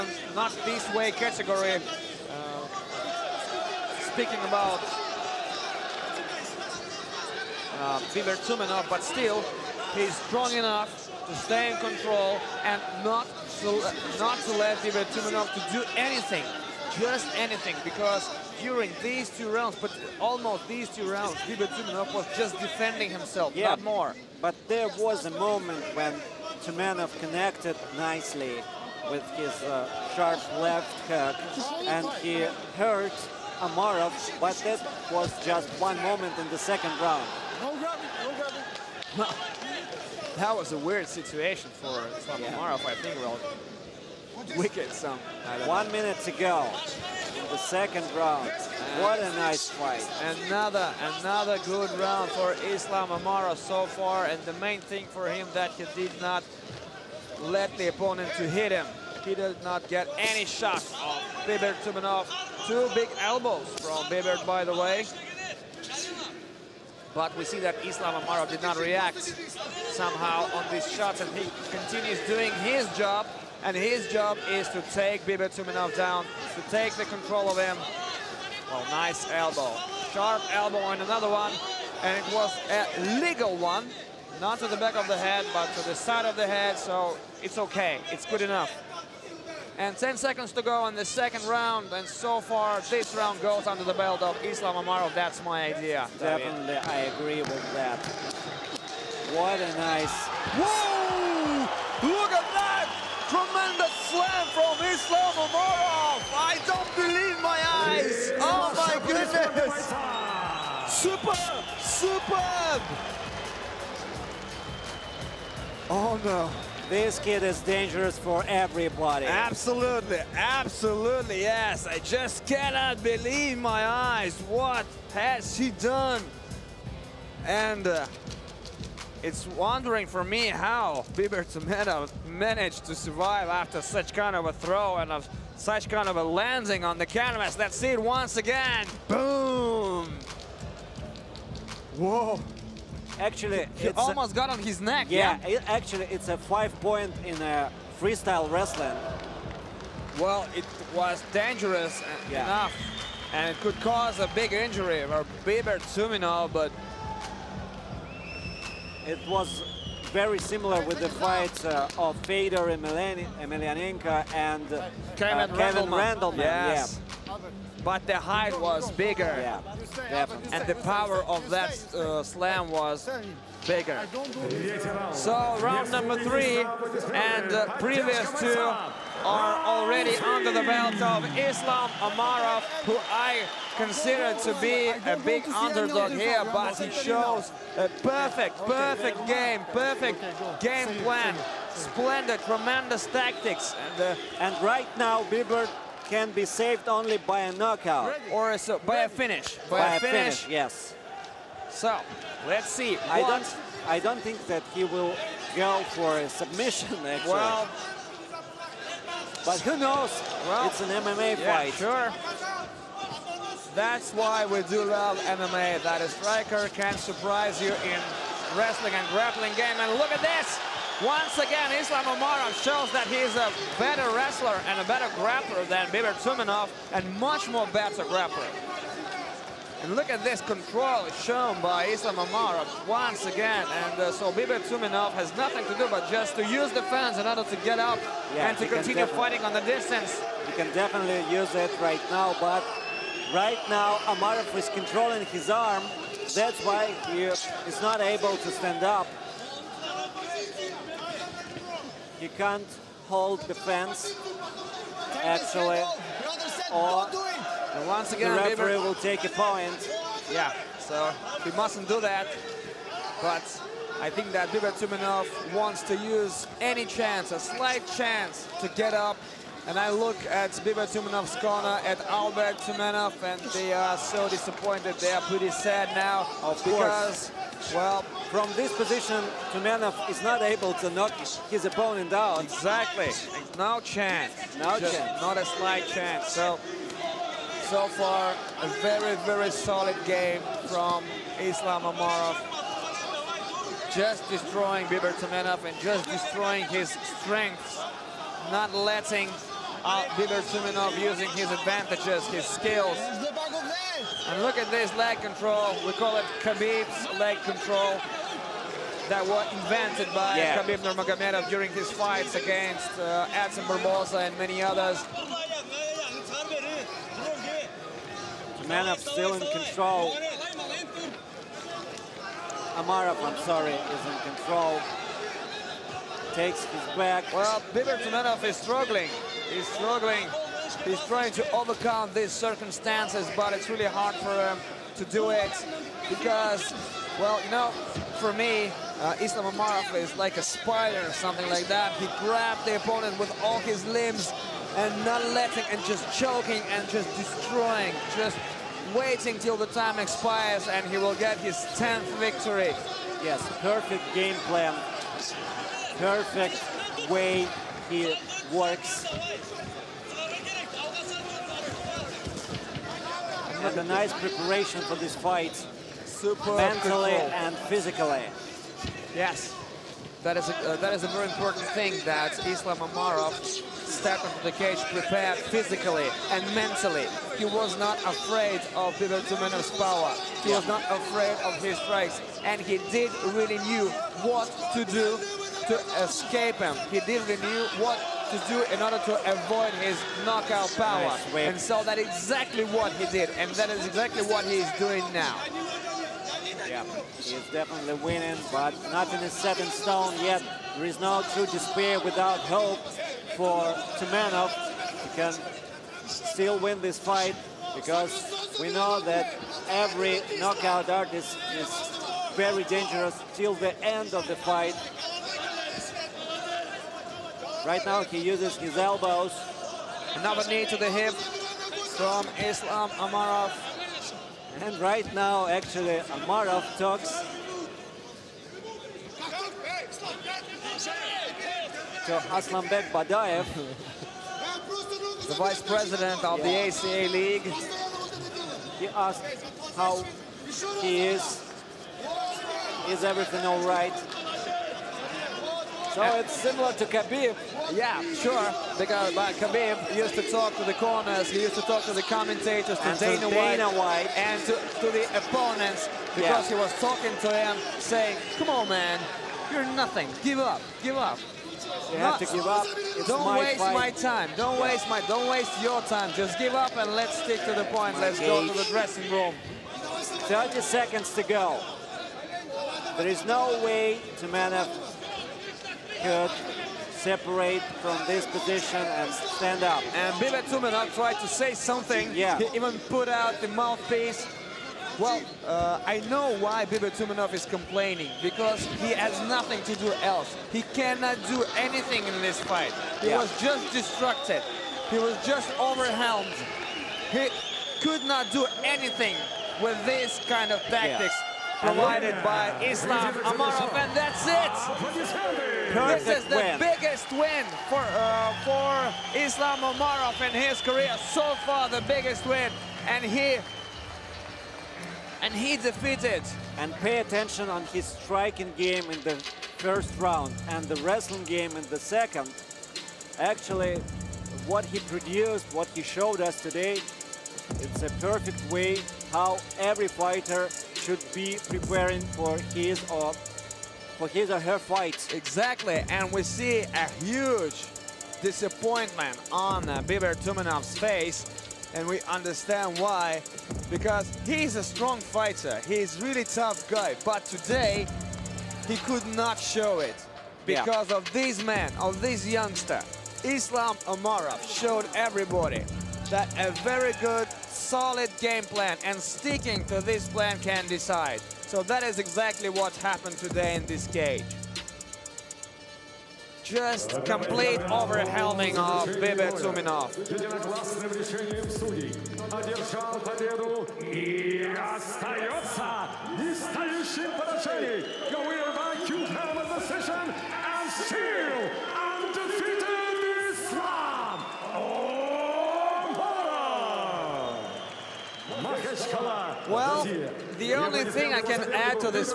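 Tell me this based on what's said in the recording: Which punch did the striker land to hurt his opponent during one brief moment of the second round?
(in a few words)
left hook.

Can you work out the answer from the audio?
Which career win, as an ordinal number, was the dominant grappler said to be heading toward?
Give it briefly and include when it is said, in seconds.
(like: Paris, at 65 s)
10th, at 351 s.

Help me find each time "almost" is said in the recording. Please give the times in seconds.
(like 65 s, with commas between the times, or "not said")
20 s, 143 s.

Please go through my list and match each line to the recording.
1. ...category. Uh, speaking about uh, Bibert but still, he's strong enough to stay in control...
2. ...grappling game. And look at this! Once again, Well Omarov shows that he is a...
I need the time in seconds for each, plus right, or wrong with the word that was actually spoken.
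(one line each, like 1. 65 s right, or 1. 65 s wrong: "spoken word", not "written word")
1. 1 s right
2. 219 s wrong: "Islam", not "Well".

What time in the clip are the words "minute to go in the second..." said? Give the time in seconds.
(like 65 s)
45 s.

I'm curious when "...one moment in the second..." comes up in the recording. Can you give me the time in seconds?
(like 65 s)
35 s.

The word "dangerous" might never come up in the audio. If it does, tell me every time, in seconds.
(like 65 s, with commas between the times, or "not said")
117 s, 151 s, 412 s.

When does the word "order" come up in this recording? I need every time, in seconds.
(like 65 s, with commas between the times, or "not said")
237 s, 388 s.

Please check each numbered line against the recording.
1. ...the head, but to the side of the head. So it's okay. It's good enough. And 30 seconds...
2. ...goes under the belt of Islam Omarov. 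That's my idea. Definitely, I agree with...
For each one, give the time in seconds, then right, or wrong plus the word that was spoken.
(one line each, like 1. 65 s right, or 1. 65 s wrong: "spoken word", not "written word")
1. 85 s wrong: "10", not "30"
2. 93 s right.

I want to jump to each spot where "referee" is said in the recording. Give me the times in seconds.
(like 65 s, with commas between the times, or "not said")
258 s.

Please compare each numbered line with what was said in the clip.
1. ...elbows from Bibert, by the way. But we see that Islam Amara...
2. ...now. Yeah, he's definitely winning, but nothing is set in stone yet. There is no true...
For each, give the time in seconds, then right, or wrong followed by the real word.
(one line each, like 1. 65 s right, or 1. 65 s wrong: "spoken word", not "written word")
1. 63 s right
2. 395 s right.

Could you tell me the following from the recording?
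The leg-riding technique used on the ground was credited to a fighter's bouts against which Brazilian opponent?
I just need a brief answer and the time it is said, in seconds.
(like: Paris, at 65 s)
Edson Barbosa, at 313 s.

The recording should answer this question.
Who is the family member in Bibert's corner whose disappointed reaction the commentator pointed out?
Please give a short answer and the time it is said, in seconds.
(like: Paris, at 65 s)
Albert Tumenov, at 272 s.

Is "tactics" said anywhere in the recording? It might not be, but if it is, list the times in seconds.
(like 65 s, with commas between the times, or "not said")
193 s, 500 s.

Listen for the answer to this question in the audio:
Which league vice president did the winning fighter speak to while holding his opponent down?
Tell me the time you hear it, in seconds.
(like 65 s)
432 s.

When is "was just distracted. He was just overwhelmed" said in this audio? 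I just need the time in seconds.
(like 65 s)
493 s.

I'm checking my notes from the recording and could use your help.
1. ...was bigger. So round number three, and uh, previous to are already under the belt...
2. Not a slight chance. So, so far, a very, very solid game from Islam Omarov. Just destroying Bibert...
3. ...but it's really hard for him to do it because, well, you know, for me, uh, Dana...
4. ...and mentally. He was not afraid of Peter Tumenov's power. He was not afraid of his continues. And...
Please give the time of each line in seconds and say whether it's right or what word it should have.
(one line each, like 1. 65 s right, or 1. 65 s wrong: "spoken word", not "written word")
1. 172 s right
2. 285 s right
3. 333 s wrong: "Islam", not "Dana"
4. 376 s wrong: "strikes", not "continues".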